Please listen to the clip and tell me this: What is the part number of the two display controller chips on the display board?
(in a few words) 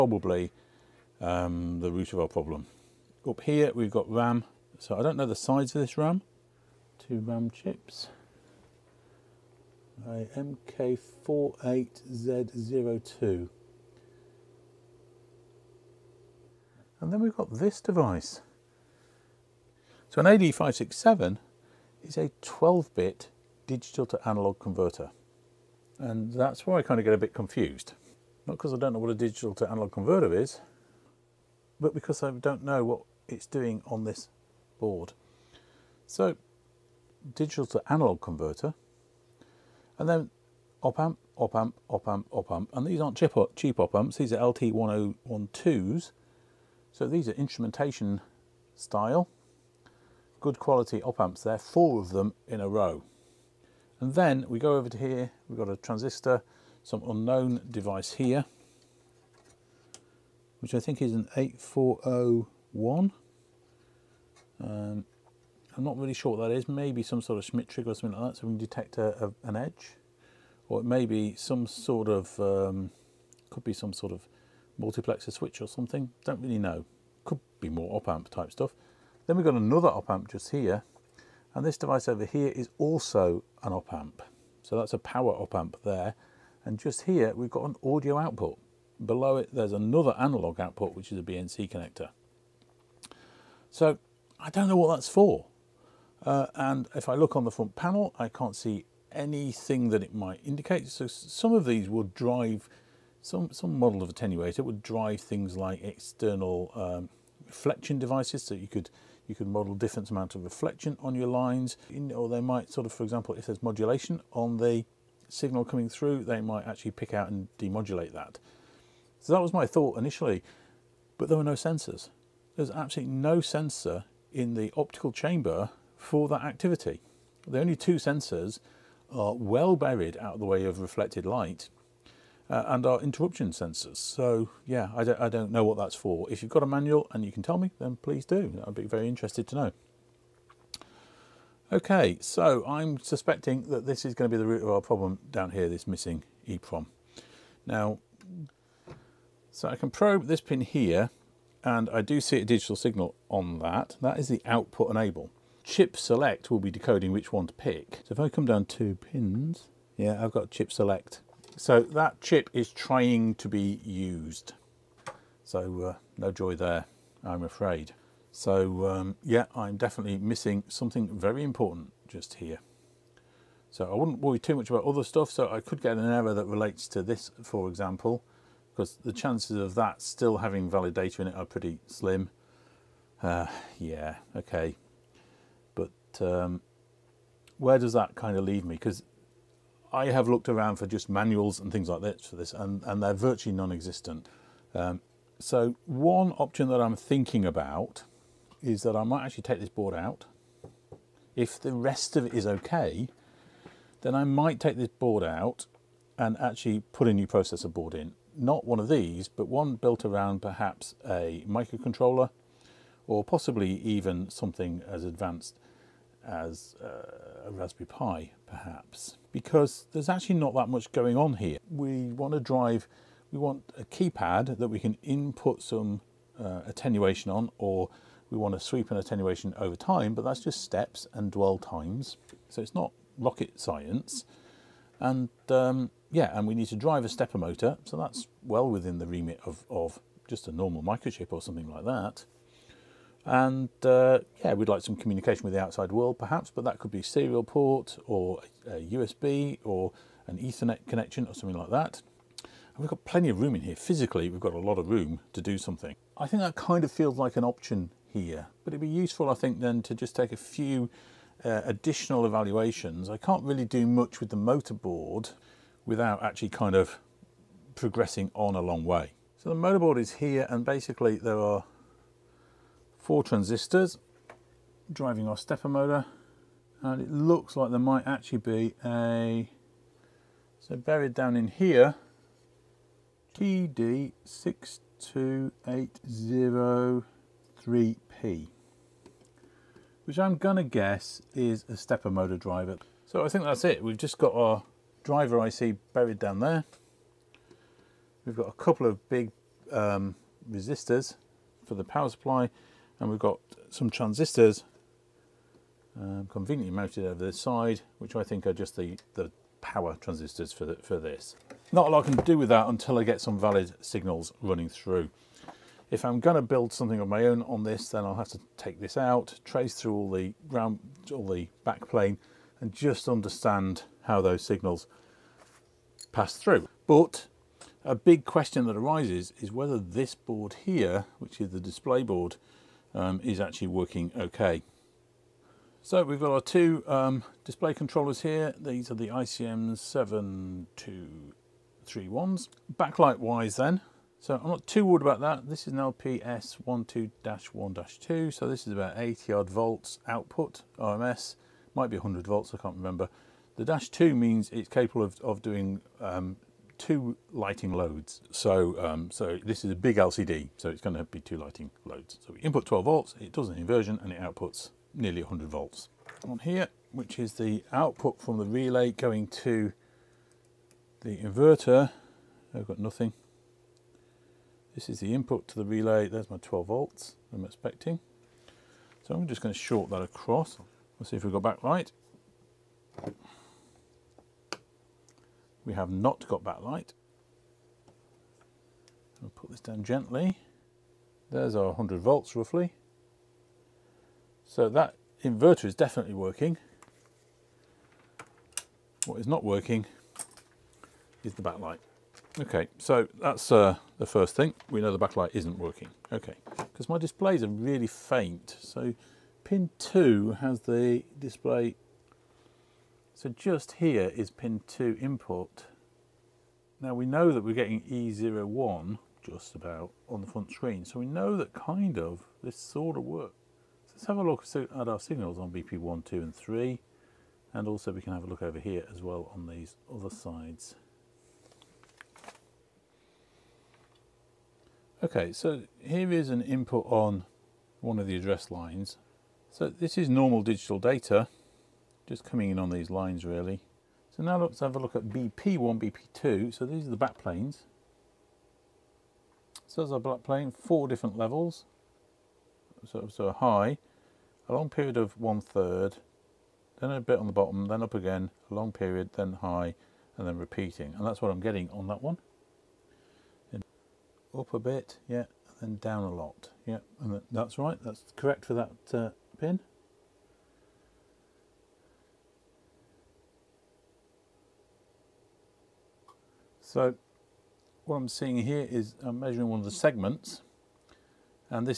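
ICM 7231.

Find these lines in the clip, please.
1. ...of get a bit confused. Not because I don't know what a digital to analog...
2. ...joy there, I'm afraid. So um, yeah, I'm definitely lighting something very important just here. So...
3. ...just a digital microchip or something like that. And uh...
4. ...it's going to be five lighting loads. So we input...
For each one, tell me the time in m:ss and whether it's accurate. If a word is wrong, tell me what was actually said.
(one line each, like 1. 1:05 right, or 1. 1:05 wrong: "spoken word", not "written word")
1. 0:26 right
2. 2:46 wrong: "missing", not "lighting"
3. 4:00 wrong: "normal", not "digital"
4. 6:00 wrong: "two", not "five".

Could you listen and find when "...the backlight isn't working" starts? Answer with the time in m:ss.
6:44.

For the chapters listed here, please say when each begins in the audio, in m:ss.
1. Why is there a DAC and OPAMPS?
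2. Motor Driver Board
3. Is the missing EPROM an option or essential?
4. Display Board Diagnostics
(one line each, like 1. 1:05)
1. 0:17
2. 4:28
3. 2:28
4. 5:29.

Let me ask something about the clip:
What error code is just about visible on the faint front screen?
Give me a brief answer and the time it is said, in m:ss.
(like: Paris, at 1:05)
E01, at 6:57.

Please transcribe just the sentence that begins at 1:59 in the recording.
So that was my thought initially, but there were no sensors.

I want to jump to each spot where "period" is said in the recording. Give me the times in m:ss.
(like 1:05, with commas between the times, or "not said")
7:34, 7:38.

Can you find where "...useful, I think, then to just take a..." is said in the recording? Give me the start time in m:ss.
4:18.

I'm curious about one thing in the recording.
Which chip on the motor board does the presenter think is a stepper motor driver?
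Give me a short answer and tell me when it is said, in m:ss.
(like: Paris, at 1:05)
TD62803P, at 4:43.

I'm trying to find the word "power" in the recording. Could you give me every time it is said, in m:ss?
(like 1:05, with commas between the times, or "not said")
1:24, 5:01, 5:09.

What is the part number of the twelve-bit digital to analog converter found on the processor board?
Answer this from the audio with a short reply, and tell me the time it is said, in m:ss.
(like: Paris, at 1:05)
AD567, at 0:20.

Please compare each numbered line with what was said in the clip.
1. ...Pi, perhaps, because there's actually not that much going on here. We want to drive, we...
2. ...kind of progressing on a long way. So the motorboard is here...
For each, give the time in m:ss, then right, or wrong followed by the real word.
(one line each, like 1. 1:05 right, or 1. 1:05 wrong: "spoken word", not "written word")
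1. 3:37 right
2. 4:26 right.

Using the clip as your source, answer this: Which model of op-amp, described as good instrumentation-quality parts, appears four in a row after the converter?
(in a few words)
LT1012.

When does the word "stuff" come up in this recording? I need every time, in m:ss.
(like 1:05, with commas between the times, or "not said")
1:18, 2:55.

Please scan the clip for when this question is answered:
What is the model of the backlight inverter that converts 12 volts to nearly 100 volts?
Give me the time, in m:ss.
5:45.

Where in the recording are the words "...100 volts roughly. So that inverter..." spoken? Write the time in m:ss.
6:31.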